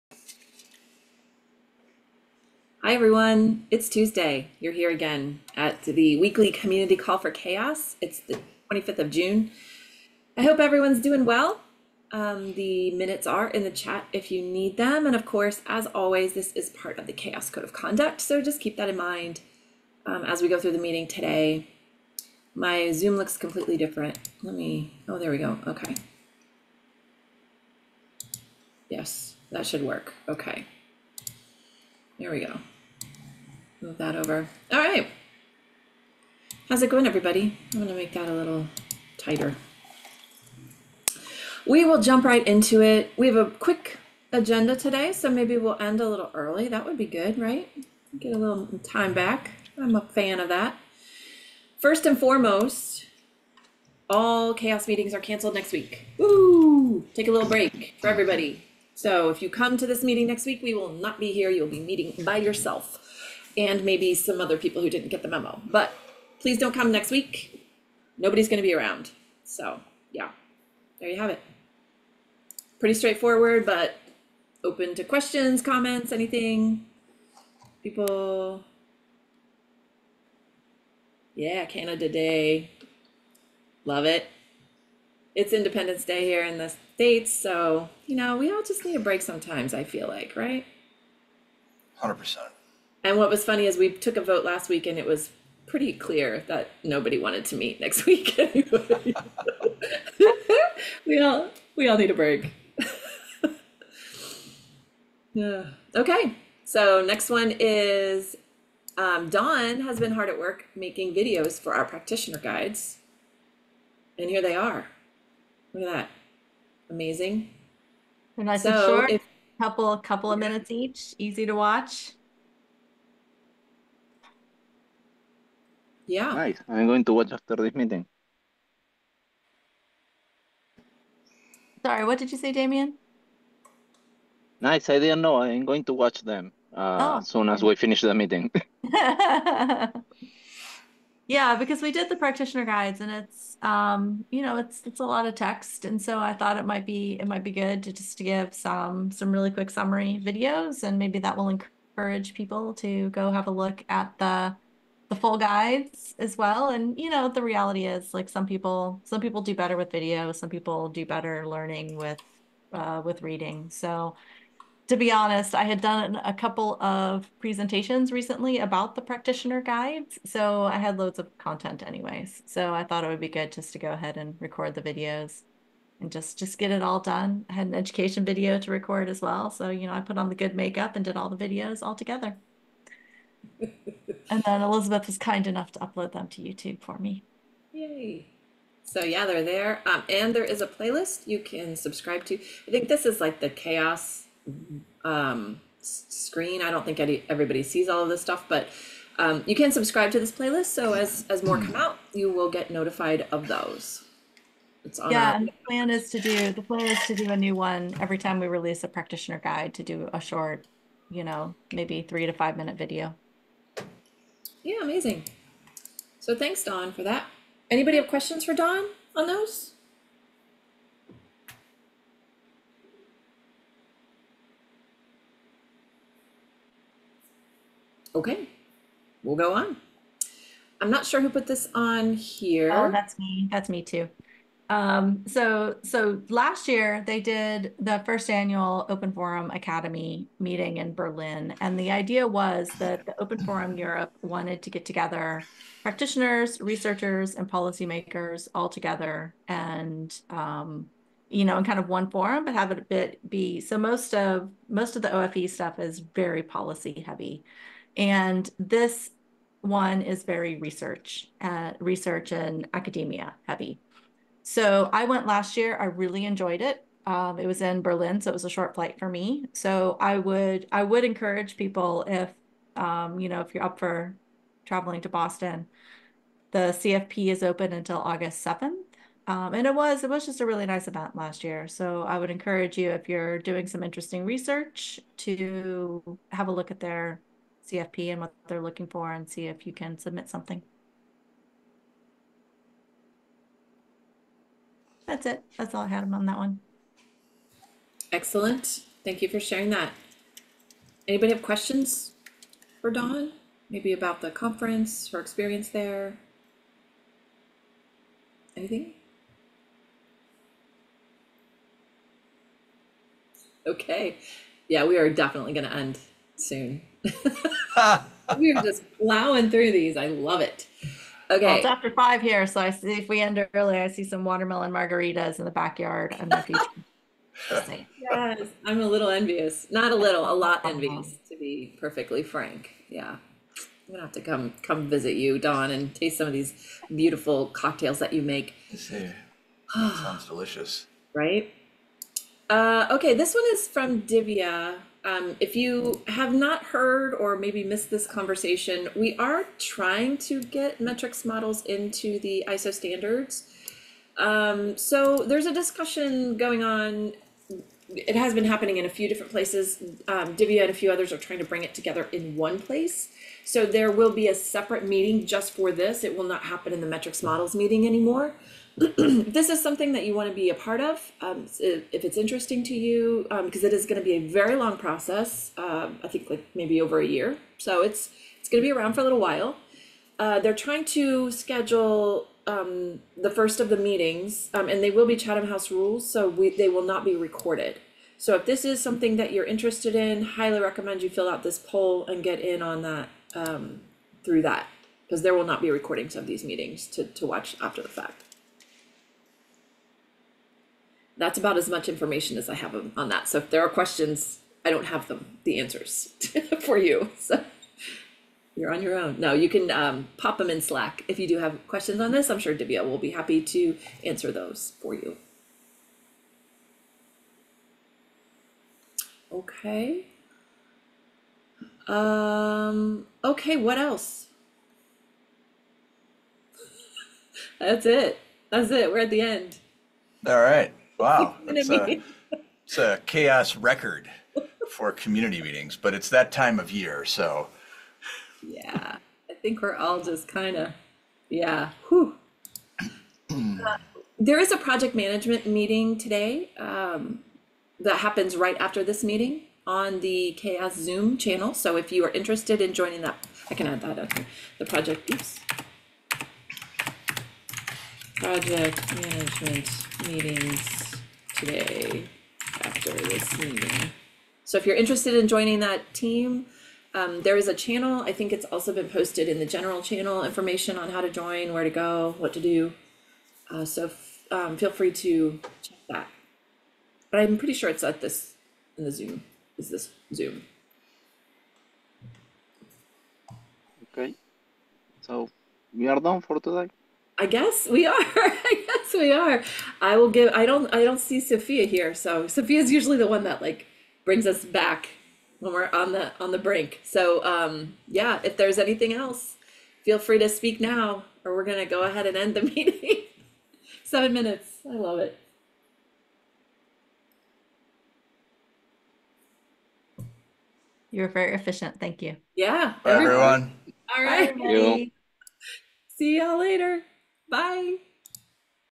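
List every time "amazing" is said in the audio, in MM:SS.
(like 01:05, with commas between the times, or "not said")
01:56, 03:34.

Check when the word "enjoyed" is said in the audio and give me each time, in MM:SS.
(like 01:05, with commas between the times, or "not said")
04:26.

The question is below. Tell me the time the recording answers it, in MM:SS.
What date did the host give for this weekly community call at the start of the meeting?
00:08.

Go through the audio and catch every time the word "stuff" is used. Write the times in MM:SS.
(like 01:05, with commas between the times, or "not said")
03:18, 04:15.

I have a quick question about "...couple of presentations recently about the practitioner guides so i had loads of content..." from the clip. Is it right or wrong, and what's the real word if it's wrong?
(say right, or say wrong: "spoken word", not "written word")
right.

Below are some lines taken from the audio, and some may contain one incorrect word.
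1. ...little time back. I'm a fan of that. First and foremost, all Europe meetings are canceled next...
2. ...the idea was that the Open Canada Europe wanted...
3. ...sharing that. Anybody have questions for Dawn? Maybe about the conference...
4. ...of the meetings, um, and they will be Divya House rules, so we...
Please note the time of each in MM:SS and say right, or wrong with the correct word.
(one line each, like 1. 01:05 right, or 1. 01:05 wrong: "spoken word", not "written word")
1. 00:48 wrong: "CHAOSS", not "Europe"
2. 04:01 wrong: "Forum", not "Canada"
3. 04:59 right
4. 06:23 wrong: "Chatham", not "Divya".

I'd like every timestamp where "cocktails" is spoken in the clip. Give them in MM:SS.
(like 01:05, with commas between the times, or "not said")
05:37.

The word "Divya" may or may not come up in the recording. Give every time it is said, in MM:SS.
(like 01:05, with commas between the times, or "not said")
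05:44, 06:00, 06:52.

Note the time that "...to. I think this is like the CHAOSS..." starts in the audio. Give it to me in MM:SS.
03:12.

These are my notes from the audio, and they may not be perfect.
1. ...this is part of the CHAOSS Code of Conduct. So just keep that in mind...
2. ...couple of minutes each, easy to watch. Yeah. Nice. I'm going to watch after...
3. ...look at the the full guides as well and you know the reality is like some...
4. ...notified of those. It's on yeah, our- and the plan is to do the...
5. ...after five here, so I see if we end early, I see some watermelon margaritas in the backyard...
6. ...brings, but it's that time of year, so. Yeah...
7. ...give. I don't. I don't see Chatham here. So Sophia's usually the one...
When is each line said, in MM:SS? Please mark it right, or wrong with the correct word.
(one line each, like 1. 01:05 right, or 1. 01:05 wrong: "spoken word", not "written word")
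1. 00:16 right
2. 01:59 right
3. 02:33 right
4. 03:22 right
5. 05:21 right
6. 07:15 wrong: "meetings", not "brings"
7. 08:10 wrong: "Sophia", not "Chatham".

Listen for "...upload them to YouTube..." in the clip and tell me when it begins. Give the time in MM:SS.
03:05.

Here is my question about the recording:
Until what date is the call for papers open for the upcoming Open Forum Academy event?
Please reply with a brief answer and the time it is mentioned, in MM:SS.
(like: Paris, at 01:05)
August 7, at 04:37.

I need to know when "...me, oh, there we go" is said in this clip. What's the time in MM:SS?
00:24.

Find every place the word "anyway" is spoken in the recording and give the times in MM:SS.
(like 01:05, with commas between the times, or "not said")
01:38, 02:51.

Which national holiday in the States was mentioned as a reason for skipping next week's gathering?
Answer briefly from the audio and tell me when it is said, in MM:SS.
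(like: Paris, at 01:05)
Independence Day, at 01:25.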